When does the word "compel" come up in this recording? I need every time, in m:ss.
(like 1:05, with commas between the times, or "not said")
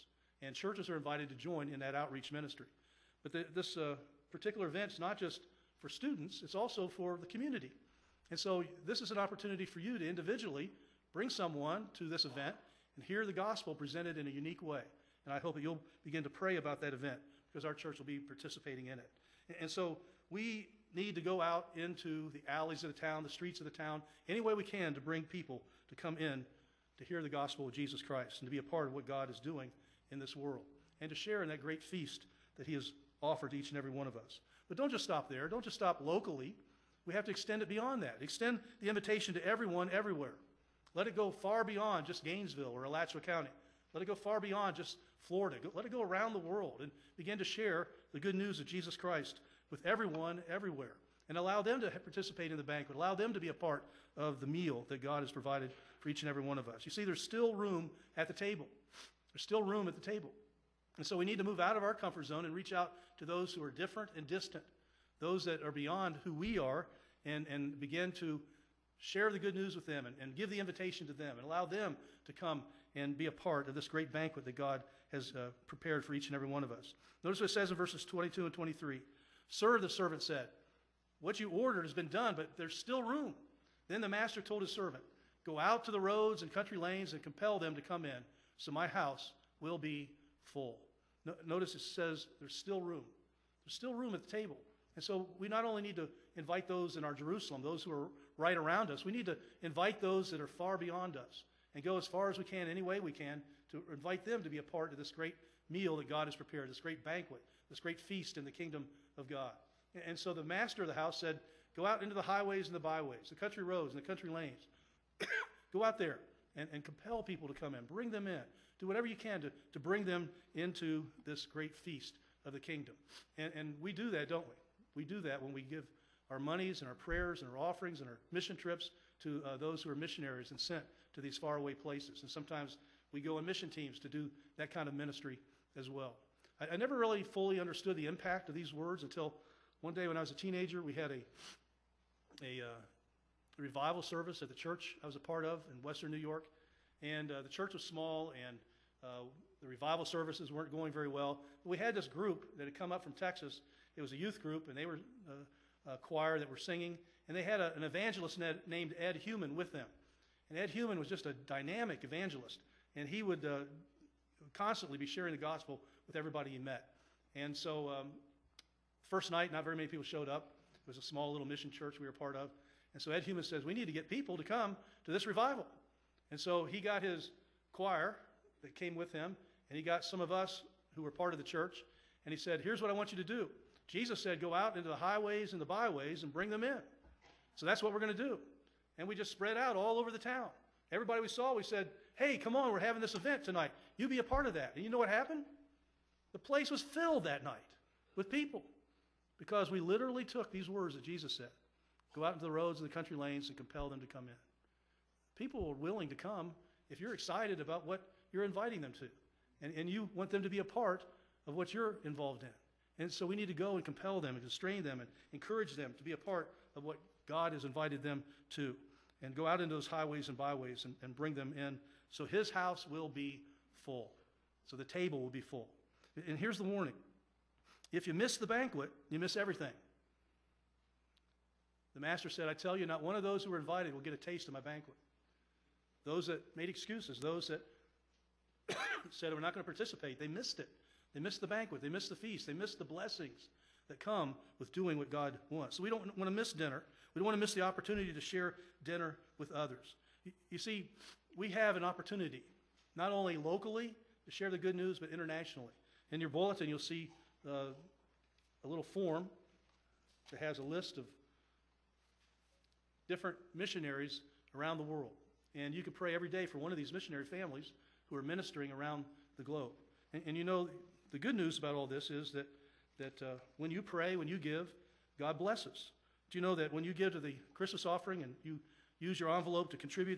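1:27, 1:56, 3:23, 3:33.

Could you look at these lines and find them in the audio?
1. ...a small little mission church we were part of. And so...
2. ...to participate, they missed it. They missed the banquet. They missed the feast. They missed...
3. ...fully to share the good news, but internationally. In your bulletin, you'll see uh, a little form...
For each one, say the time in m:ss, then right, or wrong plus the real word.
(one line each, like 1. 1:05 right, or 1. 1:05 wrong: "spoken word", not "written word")
1. 2:50 right
2. 3:59 right
3. 4:13 wrong: "locally", not "fully".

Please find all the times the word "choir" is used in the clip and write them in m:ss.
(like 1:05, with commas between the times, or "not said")
2:35, 2:57.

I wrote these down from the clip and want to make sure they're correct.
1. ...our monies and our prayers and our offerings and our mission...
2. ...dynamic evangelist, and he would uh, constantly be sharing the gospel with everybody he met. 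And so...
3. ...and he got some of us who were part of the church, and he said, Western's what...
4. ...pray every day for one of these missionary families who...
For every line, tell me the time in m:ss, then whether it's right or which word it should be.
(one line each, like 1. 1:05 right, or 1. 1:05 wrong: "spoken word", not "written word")
1. 2:06 right
2. 2:41 right
3. 2:59 wrong: "Here", not "Western"
4. 4:25 right.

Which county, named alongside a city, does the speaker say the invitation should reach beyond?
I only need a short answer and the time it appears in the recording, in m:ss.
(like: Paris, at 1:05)
Alachua County, at 0:42.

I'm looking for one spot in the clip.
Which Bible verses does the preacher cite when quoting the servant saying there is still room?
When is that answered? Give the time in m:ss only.
1:18.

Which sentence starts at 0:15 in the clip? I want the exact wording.
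And I hope that you'll begin to pray about that event because our church will be participating in it.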